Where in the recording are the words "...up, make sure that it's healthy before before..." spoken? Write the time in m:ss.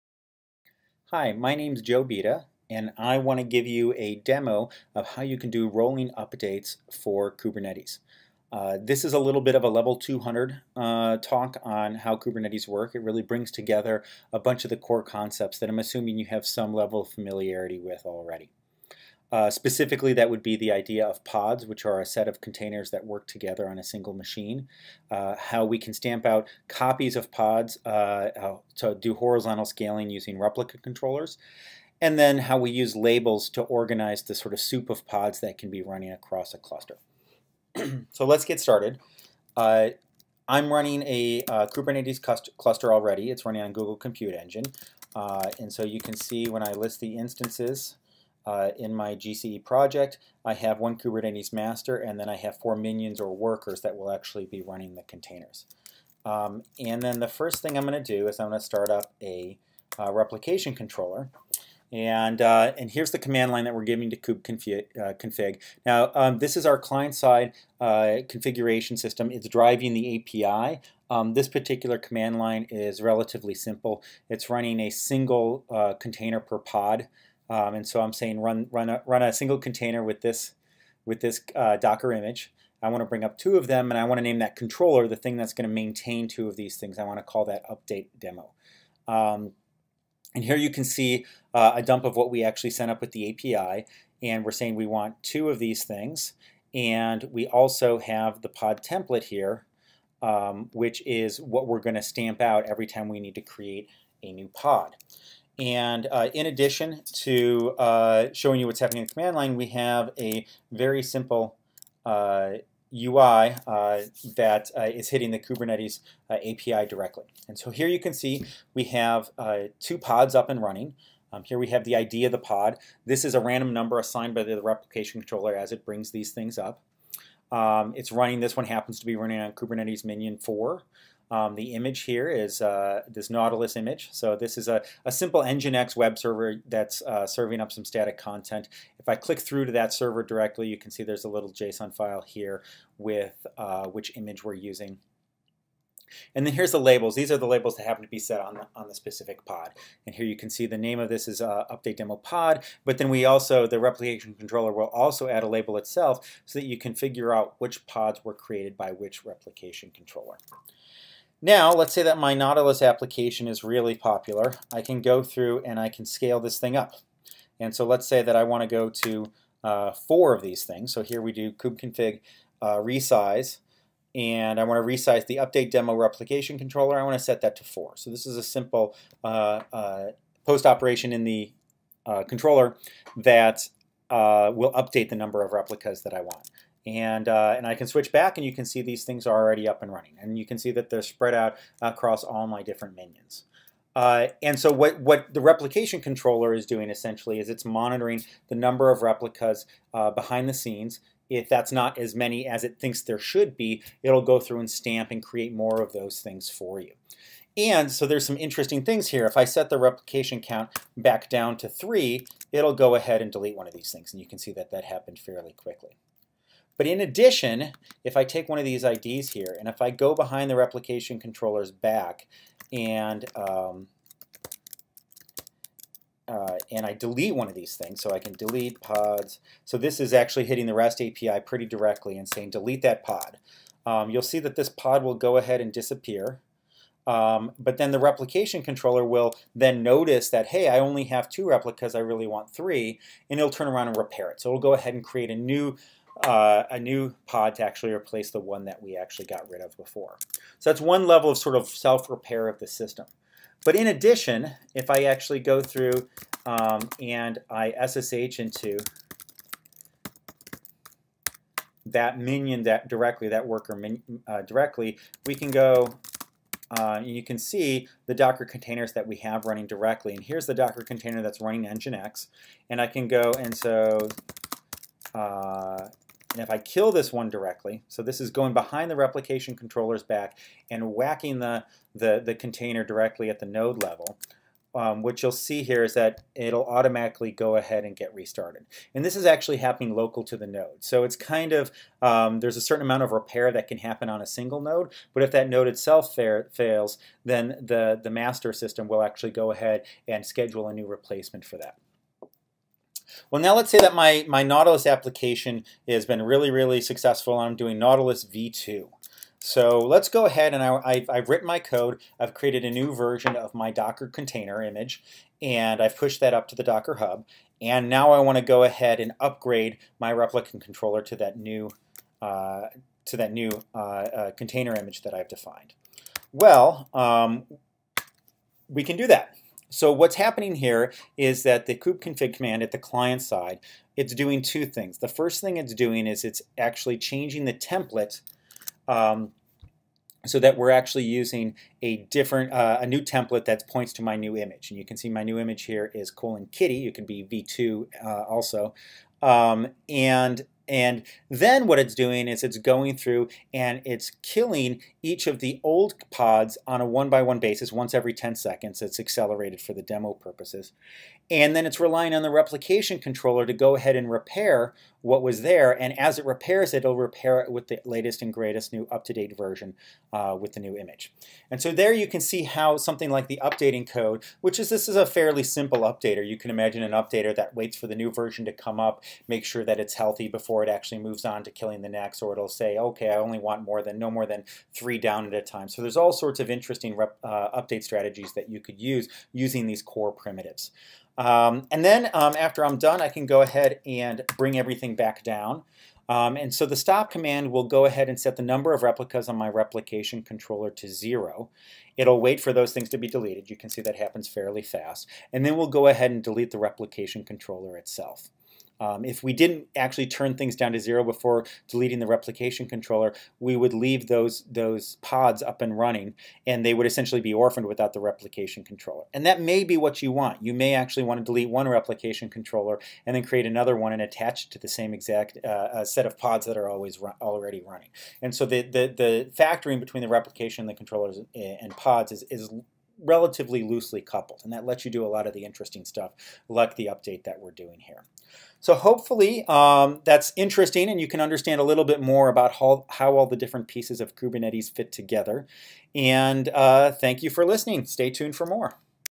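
6:18.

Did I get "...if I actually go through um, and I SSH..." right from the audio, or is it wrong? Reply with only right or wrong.
right.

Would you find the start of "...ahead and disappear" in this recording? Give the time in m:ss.
3:55.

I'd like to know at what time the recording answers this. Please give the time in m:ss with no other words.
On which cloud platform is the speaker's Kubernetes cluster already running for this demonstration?
0:43.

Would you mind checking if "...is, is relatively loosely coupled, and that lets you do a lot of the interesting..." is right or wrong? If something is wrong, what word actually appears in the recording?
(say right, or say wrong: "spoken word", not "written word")
right.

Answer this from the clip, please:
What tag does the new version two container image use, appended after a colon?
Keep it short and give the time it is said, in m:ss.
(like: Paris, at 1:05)
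kitty, at 5:46.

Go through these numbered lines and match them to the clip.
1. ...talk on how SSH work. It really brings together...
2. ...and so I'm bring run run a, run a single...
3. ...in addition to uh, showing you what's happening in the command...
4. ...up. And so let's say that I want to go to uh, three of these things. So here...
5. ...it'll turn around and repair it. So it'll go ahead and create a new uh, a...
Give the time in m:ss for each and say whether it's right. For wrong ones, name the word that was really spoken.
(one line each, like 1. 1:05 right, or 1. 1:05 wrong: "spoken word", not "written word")
1. 0:11 wrong: "Kubernetes", not "SSH"
2. 1:17 wrong: "saying", not "bring"
3. 1:46 right
4. 2:46 wrong: "four", not "three"
5. 4:03 right.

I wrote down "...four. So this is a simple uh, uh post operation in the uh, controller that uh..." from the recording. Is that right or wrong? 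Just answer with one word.
right.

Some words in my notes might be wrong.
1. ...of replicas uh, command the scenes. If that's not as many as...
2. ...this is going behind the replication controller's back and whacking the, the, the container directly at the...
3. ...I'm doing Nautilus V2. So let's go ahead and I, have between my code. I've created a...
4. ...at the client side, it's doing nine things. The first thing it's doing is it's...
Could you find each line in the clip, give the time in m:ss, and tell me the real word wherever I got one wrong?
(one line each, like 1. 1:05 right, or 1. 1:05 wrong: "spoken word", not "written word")
1. 3:18 wrong: "behind", not "command"
2. 4:38 right
3. 5:07 wrong: "written", not "between"
4. 5:32 wrong: "two", not "nine".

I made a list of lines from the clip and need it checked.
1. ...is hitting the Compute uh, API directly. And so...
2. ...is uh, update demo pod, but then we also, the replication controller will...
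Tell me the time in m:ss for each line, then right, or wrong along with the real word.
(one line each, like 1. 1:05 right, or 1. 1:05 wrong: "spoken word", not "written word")
1. 1:54 wrong: "Kubernetes", not "Compute"
2. 2:31 right.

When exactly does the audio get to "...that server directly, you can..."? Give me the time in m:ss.
2:19.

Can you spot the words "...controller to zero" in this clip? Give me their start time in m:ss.
6:40.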